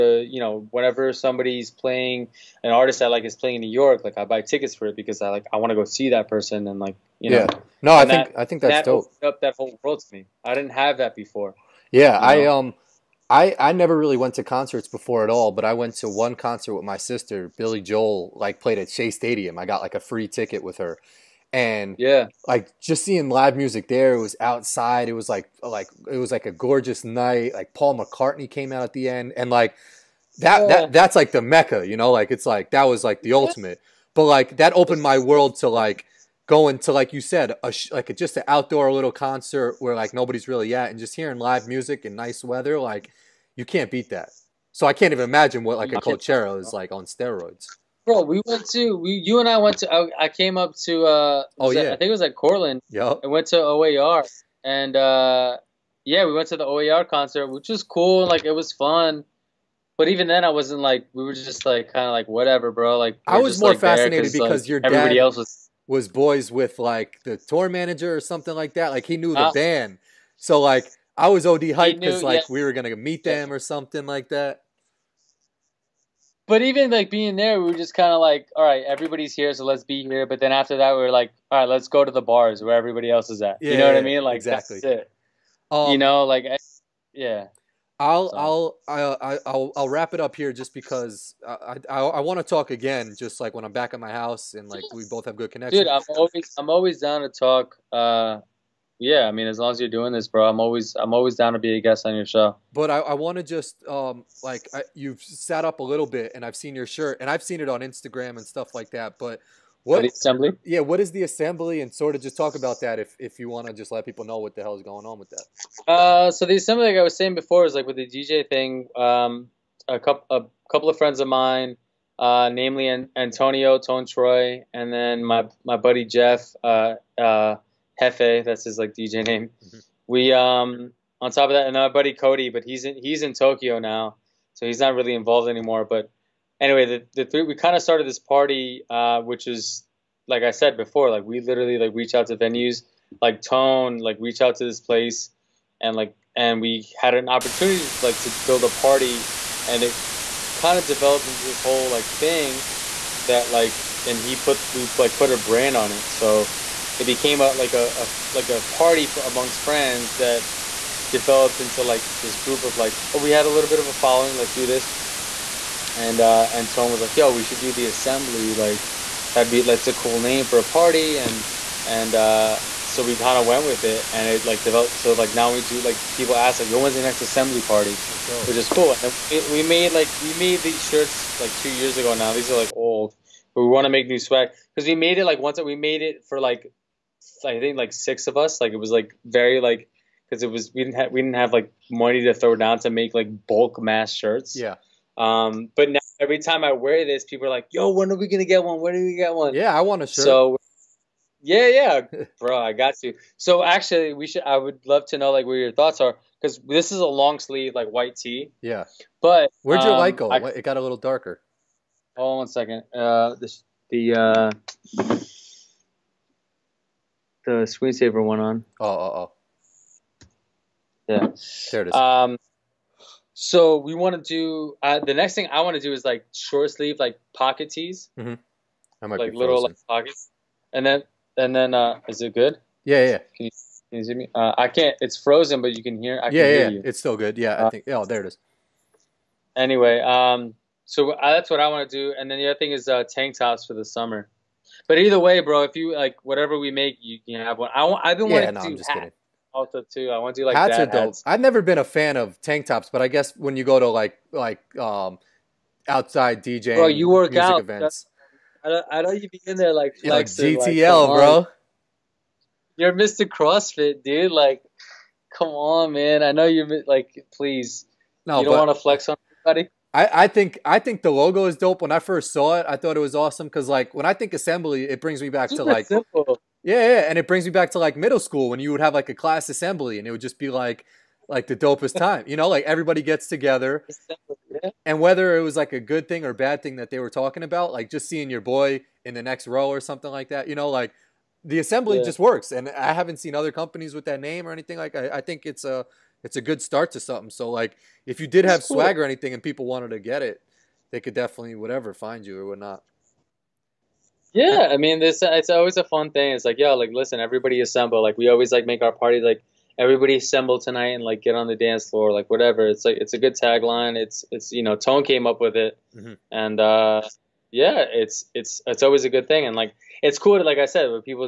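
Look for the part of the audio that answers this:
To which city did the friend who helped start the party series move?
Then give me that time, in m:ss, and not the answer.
2:13.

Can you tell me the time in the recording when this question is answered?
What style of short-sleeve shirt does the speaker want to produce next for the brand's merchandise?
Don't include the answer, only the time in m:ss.
3:47.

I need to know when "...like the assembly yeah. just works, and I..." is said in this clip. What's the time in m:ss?
4:50.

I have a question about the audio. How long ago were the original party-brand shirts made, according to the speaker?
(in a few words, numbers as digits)
2 years ago.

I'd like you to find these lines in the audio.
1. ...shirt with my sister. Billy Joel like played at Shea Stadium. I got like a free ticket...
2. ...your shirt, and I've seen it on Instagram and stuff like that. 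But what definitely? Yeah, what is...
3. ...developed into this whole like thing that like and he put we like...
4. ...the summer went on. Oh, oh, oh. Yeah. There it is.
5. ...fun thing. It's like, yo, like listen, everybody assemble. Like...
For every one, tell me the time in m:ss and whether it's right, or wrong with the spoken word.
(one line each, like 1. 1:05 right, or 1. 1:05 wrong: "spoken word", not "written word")
1. 0:16 wrong: "concert", not "shirt"
2. 1:46 wrong: "assembly", not "definitely"
3. 2:30 right
4. 3:37 wrong: "screensaver", not "summer"
5. 5:05 right.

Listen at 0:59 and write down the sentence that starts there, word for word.
But even then, I wasn't like we were just like kind of like whatever, bro.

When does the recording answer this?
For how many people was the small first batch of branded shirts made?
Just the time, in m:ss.
3:07.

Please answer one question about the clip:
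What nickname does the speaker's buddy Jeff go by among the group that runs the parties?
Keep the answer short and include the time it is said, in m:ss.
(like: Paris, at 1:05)
Hefe, at 2:07.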